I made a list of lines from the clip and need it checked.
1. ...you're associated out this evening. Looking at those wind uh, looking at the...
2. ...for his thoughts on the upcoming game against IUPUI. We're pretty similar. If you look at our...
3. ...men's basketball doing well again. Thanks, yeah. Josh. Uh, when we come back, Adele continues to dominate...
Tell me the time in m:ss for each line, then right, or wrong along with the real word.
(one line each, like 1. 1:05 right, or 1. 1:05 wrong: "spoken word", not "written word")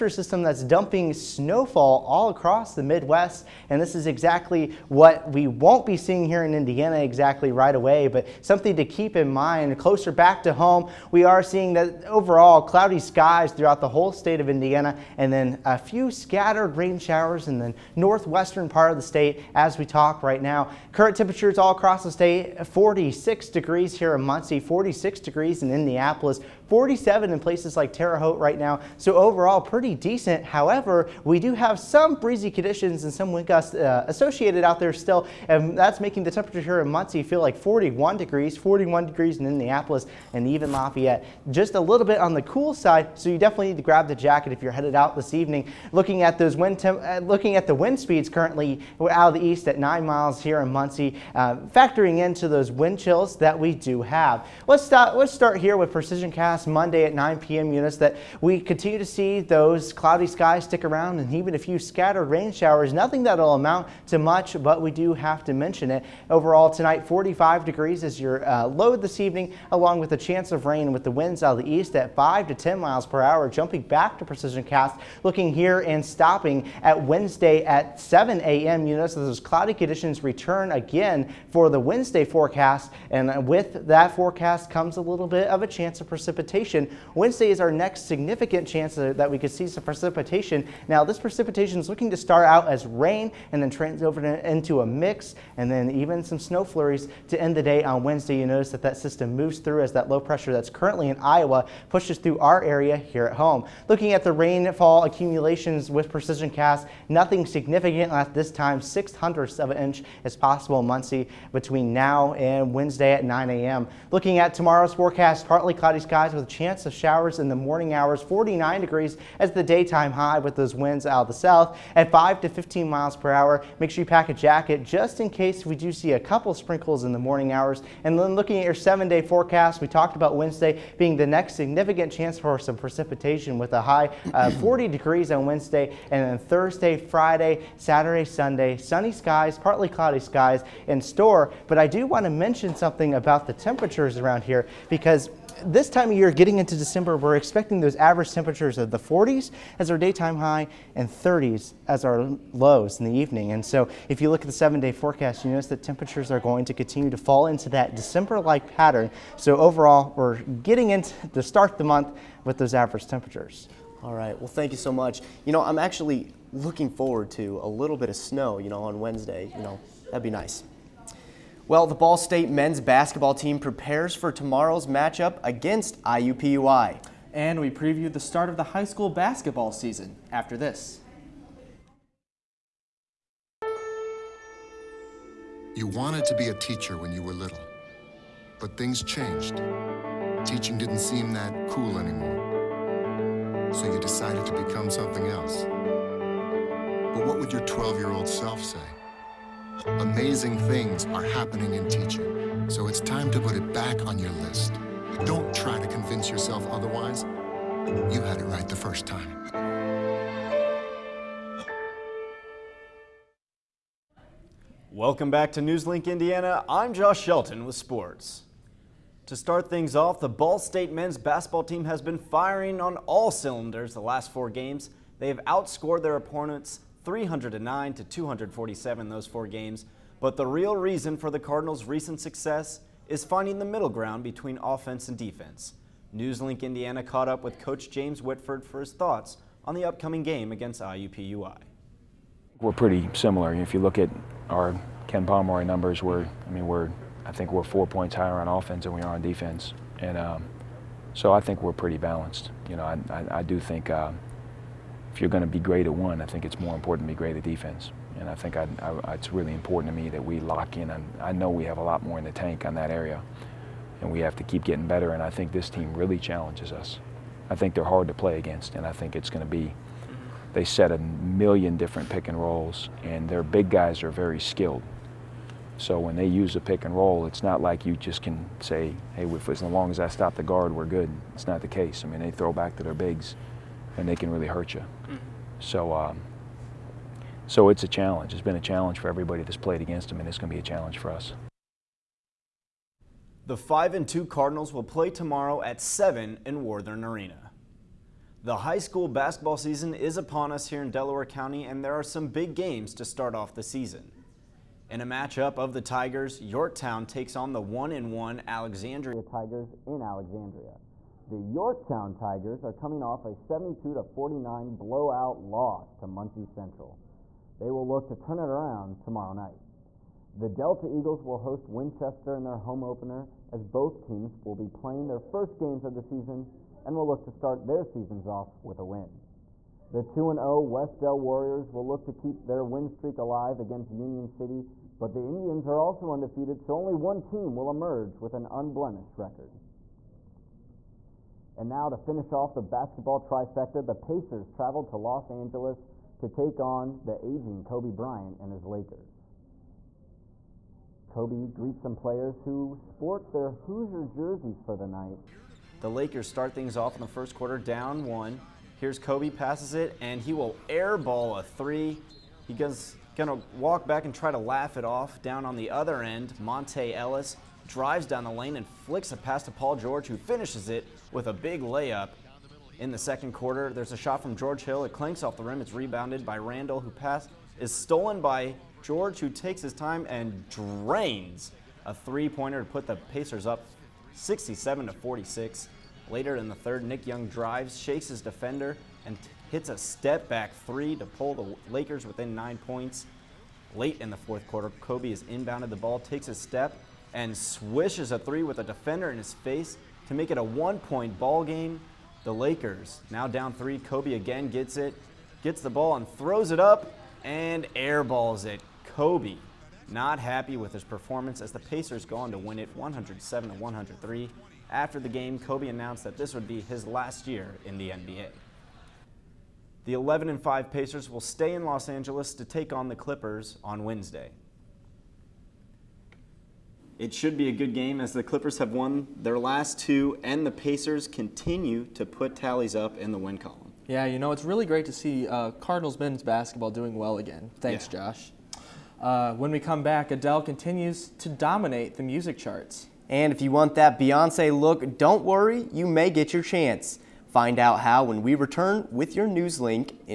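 1. 0:44 wrong: "headed", not "associated"
2. 3:58 right
3. 7:15 right.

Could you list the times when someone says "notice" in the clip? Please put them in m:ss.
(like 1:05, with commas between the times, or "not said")
1:18, 1:38, 2:35.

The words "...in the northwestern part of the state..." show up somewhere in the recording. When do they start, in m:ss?
0:17.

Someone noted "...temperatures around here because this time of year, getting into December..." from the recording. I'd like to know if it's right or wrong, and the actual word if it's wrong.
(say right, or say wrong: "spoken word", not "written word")
right.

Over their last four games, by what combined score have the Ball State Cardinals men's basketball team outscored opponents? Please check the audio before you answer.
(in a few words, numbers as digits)
309 to 247.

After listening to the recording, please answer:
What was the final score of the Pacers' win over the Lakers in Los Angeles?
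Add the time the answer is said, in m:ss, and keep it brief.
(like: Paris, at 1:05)
107 to 103, at 6:52.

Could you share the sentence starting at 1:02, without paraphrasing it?
Nothing that'll amount to much, but we do have to mention it.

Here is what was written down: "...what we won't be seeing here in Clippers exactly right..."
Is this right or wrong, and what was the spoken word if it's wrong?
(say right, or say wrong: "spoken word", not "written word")
wrong: "Indiana", not "Clippers".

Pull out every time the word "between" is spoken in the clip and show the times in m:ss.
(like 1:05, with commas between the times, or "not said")
1:51, 3:54.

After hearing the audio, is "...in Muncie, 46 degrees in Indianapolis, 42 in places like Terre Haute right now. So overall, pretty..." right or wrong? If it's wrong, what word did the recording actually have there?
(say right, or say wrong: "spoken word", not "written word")
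wrong: "47", not "42".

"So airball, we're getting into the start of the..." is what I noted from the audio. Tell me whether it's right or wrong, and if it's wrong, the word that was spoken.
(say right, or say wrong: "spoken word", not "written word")
wrong: "overall", not "airball".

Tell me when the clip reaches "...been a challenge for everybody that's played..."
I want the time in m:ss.
4:48.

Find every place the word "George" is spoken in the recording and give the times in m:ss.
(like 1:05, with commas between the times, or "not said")
6:09, 6:14, 6:18.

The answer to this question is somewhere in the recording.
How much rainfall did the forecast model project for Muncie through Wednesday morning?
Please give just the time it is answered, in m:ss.
1:48.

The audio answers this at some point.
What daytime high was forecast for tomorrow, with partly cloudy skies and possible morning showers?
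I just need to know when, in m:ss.
1:58.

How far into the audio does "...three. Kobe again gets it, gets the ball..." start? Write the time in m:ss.
6:43.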